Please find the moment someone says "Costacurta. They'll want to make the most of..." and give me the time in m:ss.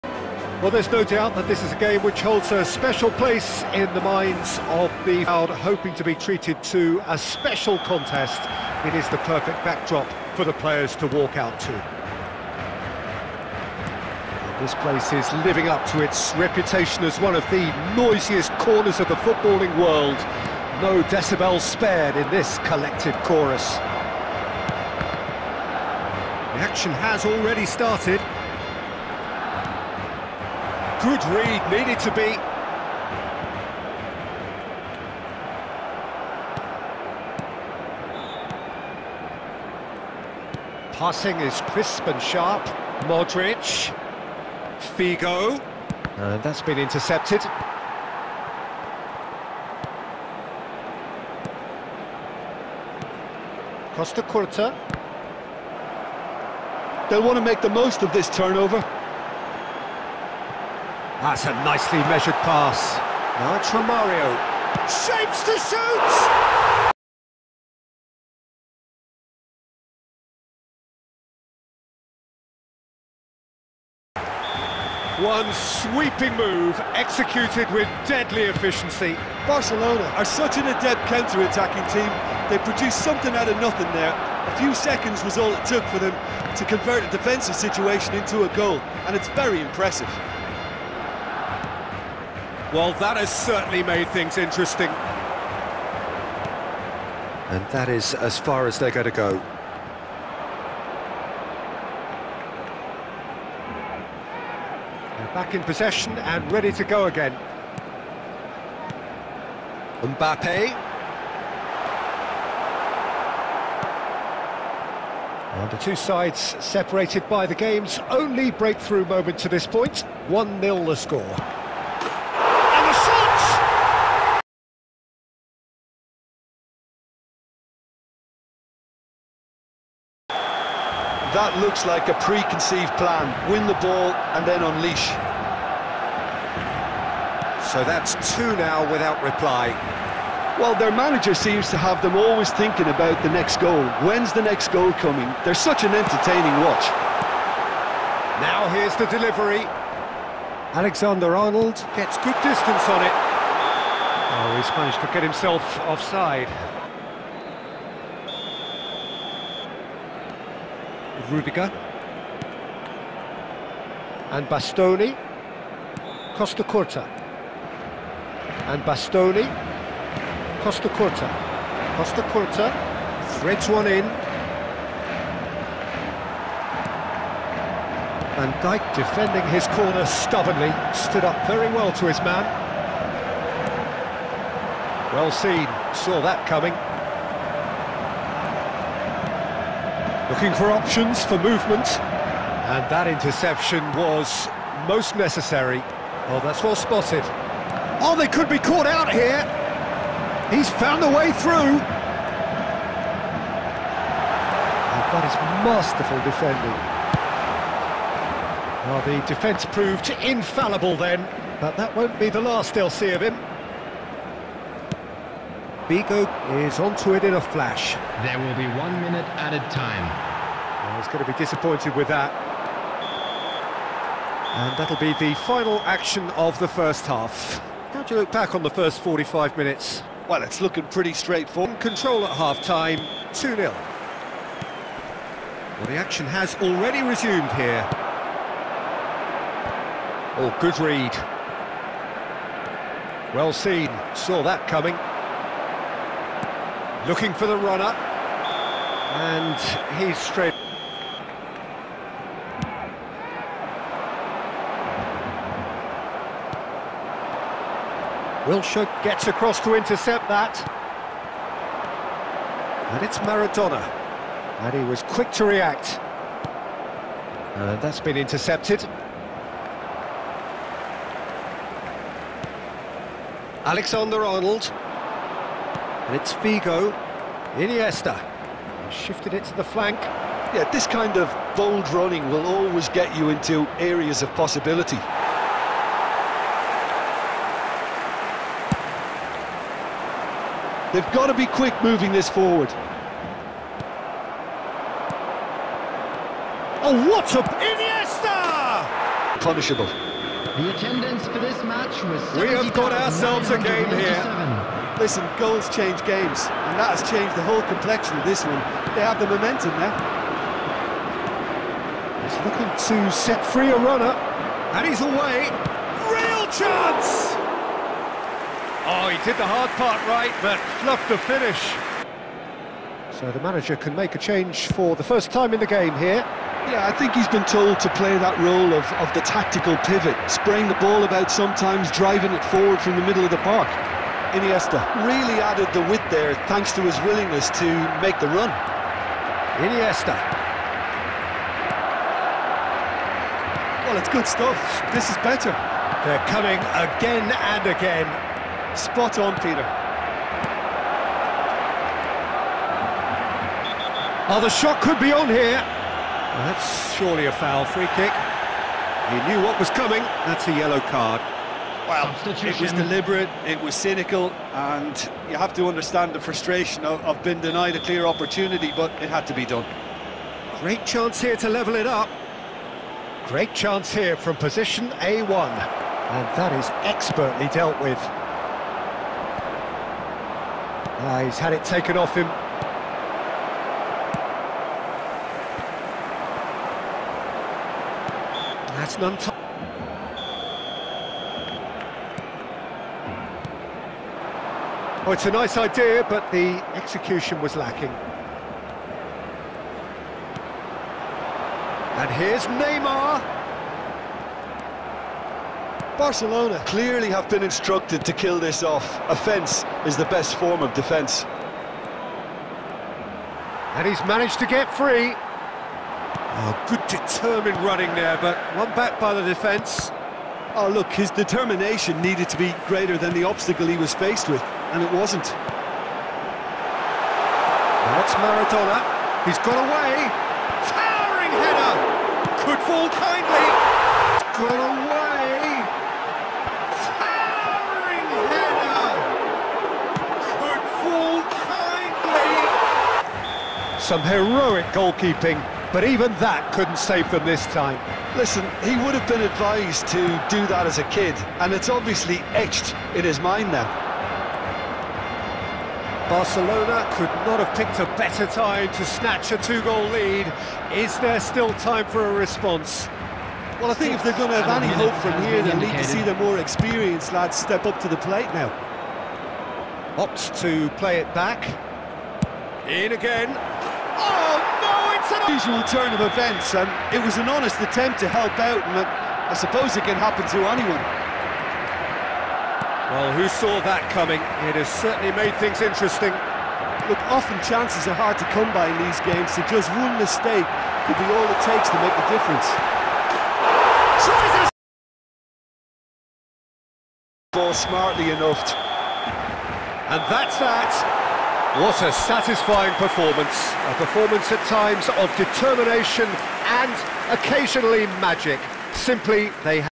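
0:53.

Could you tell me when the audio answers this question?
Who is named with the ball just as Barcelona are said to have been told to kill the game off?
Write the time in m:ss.
6:42.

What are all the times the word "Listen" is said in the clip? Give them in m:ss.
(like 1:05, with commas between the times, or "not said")
5:05, 7:28.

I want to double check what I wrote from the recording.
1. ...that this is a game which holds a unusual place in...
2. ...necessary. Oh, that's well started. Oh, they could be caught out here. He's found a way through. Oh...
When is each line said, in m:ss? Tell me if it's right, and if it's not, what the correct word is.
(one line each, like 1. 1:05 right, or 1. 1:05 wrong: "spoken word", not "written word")
1. 0:01 wrong: "special", not "unusual"
2. 3:15 wrong: "spotted", not "started".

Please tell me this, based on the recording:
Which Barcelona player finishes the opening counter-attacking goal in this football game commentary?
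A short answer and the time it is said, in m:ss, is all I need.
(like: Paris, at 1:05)
Romario, at 1:03.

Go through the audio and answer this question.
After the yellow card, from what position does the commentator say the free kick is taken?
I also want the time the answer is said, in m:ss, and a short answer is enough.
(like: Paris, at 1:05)
A1, at 6:15.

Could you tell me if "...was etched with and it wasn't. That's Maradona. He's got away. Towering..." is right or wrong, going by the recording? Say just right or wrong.
wrong.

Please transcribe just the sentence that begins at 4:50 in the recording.
They've got to be quick moving this forward.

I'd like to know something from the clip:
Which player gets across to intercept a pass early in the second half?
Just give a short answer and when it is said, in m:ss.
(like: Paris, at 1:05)
Wilshere, at 4:18.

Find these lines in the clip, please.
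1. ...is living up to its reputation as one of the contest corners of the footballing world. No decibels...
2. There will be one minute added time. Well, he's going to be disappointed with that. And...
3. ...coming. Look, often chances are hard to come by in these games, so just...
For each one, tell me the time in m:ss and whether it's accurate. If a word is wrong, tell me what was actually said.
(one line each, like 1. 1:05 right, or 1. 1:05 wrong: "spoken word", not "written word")
1. 0:15 wrong: "noisiest", not "contest"
2. 3:38 right
3. 8:05 wrong: "interesting", not "coming".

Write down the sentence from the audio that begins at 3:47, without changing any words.
How do you look back on the first 45 minutes?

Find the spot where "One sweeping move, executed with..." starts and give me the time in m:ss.
1:15.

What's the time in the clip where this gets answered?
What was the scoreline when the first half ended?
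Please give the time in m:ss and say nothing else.
3:53.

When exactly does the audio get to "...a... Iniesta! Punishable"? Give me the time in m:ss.
4:57.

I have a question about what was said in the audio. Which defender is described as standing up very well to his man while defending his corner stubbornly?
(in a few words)
Van Dijk.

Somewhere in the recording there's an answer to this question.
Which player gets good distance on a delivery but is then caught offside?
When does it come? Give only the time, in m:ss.
2:30.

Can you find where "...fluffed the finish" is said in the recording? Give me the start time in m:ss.
5:20.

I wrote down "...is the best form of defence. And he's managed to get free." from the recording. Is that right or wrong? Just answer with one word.
right.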